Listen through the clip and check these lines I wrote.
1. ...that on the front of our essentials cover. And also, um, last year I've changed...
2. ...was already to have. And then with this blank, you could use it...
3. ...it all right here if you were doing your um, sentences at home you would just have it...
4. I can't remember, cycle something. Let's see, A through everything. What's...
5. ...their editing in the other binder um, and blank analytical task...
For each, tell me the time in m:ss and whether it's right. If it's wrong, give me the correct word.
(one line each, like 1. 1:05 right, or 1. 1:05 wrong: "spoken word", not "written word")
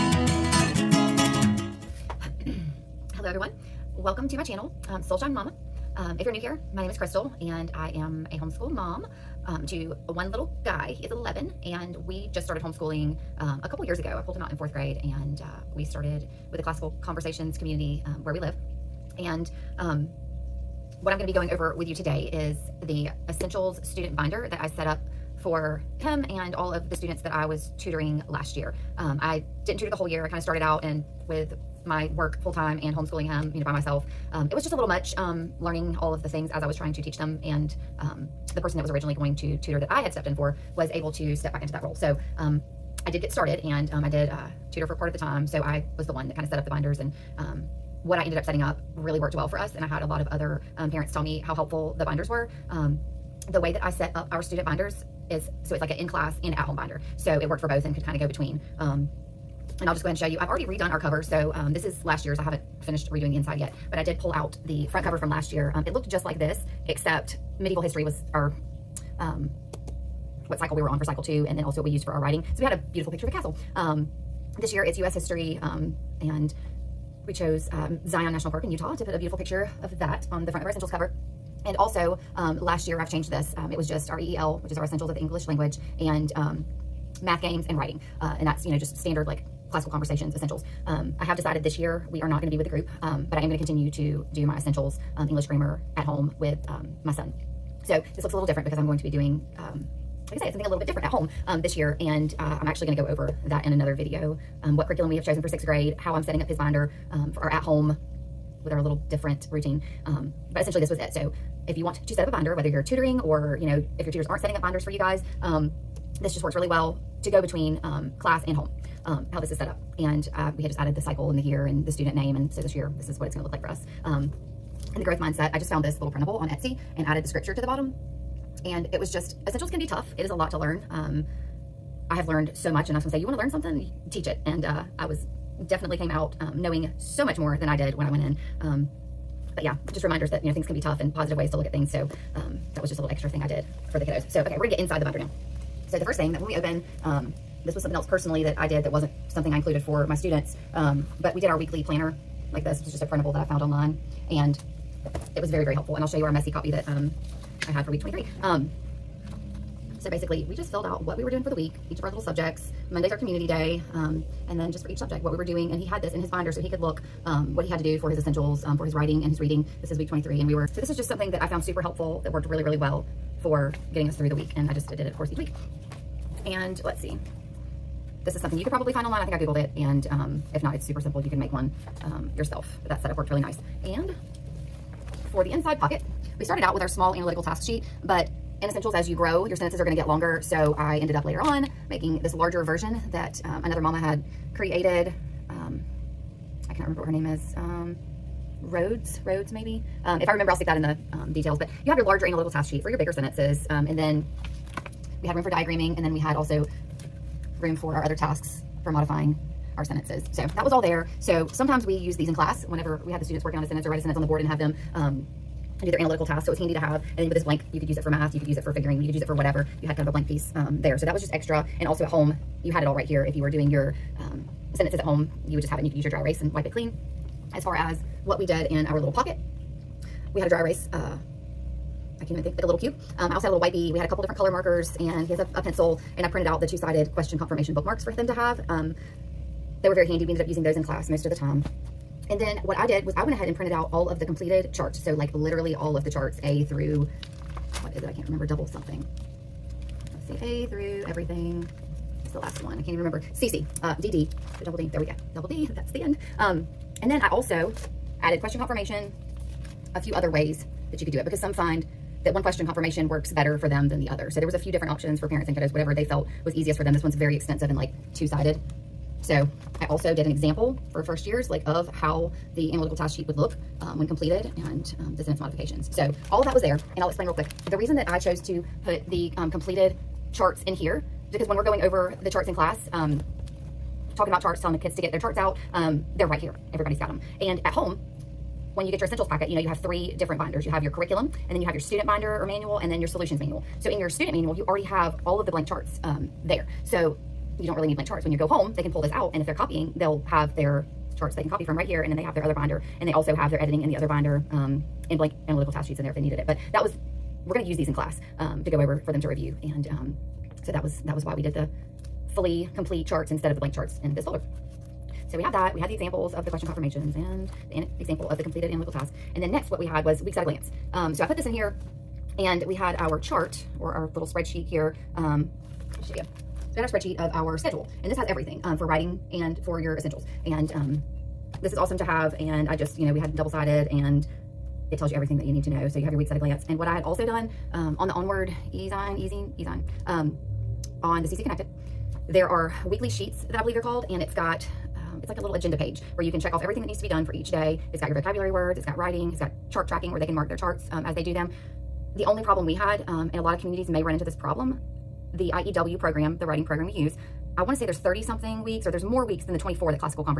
1. 1:19 right
2. 3:36 wrong: "handy", not "already"
3. 3:42 right
4. 4:08 wrong: "double", not "cycle"
5. 5:03 right.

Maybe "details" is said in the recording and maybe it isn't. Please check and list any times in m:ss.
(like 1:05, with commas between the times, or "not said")
3:21.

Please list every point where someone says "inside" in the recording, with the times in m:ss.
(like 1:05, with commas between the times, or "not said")
1:03, 2:24, 3:05.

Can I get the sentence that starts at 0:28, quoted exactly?
Um, I didn't tutor the whole year.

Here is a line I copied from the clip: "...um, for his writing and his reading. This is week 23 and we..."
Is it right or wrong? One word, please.
right.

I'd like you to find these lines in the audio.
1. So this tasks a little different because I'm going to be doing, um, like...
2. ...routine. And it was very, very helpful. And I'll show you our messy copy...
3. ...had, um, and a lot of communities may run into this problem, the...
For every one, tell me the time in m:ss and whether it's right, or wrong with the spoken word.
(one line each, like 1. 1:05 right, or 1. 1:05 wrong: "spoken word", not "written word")
1. 1:37 wrong: "looks", not "tasks"
2. 2:33 wrong: "online", not "routine"
3. 5:52 right.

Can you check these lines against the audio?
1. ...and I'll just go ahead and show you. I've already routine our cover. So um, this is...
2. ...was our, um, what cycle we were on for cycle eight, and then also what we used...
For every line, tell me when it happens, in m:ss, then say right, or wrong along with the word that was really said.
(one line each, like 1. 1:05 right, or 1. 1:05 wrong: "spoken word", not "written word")
1. 0:59 wrong: "redone", not "routine"
2. 1:08 wrong: "two", not "eight".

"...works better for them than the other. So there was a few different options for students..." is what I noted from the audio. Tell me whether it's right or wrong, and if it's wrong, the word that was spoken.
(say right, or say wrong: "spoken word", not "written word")
wrong: "parents", not "students".